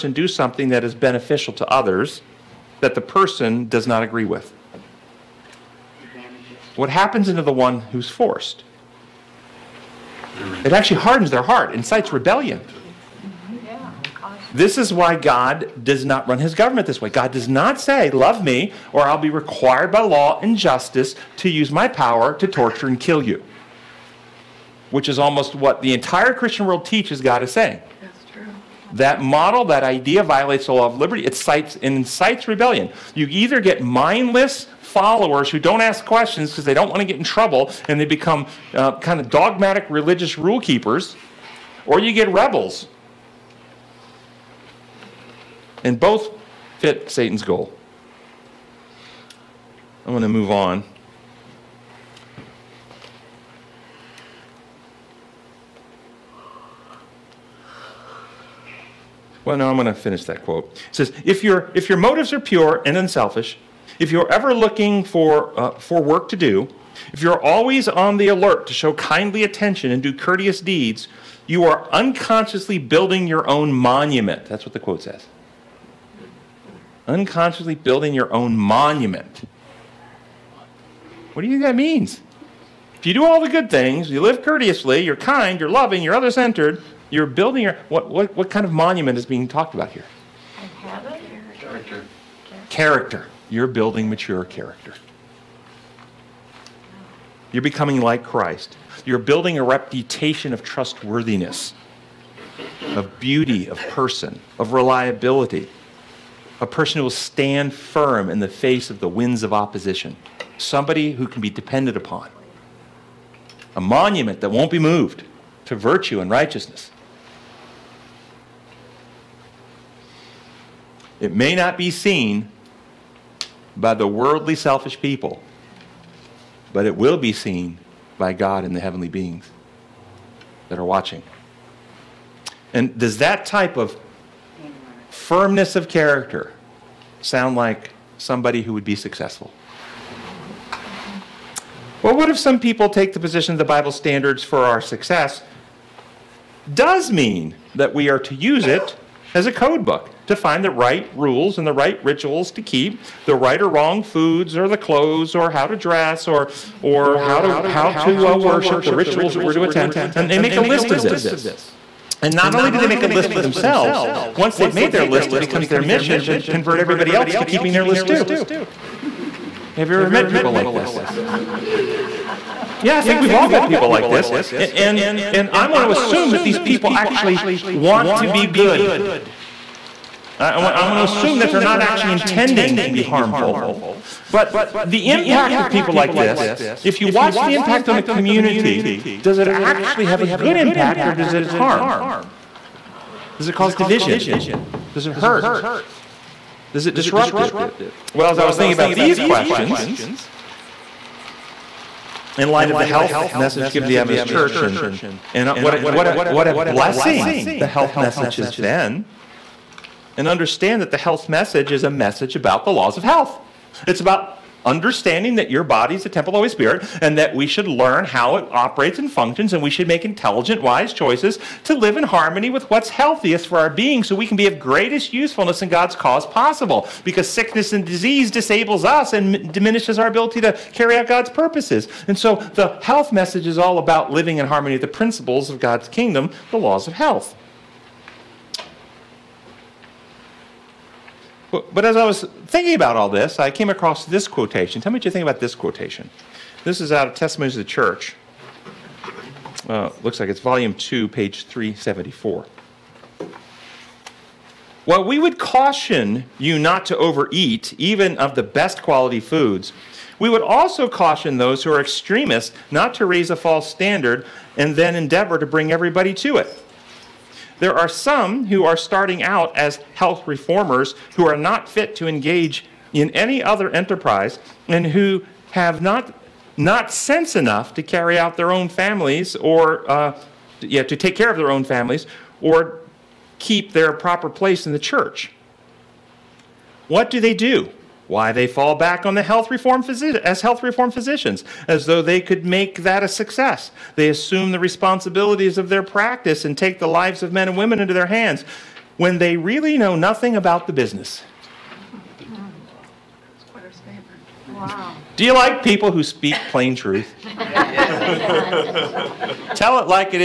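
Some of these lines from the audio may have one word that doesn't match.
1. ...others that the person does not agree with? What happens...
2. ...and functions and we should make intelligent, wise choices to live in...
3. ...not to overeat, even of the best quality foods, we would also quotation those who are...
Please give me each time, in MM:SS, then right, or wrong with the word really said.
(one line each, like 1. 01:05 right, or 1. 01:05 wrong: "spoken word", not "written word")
1. 00:01 right
2. 03:38 right
3. 04:16 wrong: "caution", not "quotation".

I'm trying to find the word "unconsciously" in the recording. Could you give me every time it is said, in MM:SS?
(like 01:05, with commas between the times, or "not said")
01:11, 01:17.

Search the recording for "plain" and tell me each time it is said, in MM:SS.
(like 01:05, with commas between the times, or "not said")
05:06.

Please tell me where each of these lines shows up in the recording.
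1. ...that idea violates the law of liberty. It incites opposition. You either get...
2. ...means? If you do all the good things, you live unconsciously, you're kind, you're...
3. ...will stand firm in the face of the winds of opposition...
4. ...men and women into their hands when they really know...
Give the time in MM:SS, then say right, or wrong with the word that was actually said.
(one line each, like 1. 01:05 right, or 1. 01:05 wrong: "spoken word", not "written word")
1. 00:29 wrong: "rebellion", not "opposition"
2. 01:21 wrong: "courteously", not "unconsciously"
3. 01:47 right
4. 04:57 right.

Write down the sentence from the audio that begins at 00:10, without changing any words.
It actually hardens their heart, incites rebellion.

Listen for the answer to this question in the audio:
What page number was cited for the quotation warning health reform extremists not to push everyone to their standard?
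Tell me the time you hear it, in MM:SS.
04:11.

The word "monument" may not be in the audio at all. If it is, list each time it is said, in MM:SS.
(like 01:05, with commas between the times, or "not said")
01:13, 01:18, 01:28, 01:53.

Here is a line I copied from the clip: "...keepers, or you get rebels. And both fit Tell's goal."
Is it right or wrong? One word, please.
wrong.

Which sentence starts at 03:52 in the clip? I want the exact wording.
And so the health message is all about living in harmony with the principles of God's kingdom, the laws of health.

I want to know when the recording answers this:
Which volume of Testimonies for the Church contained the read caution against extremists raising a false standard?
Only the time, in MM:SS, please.
04:10.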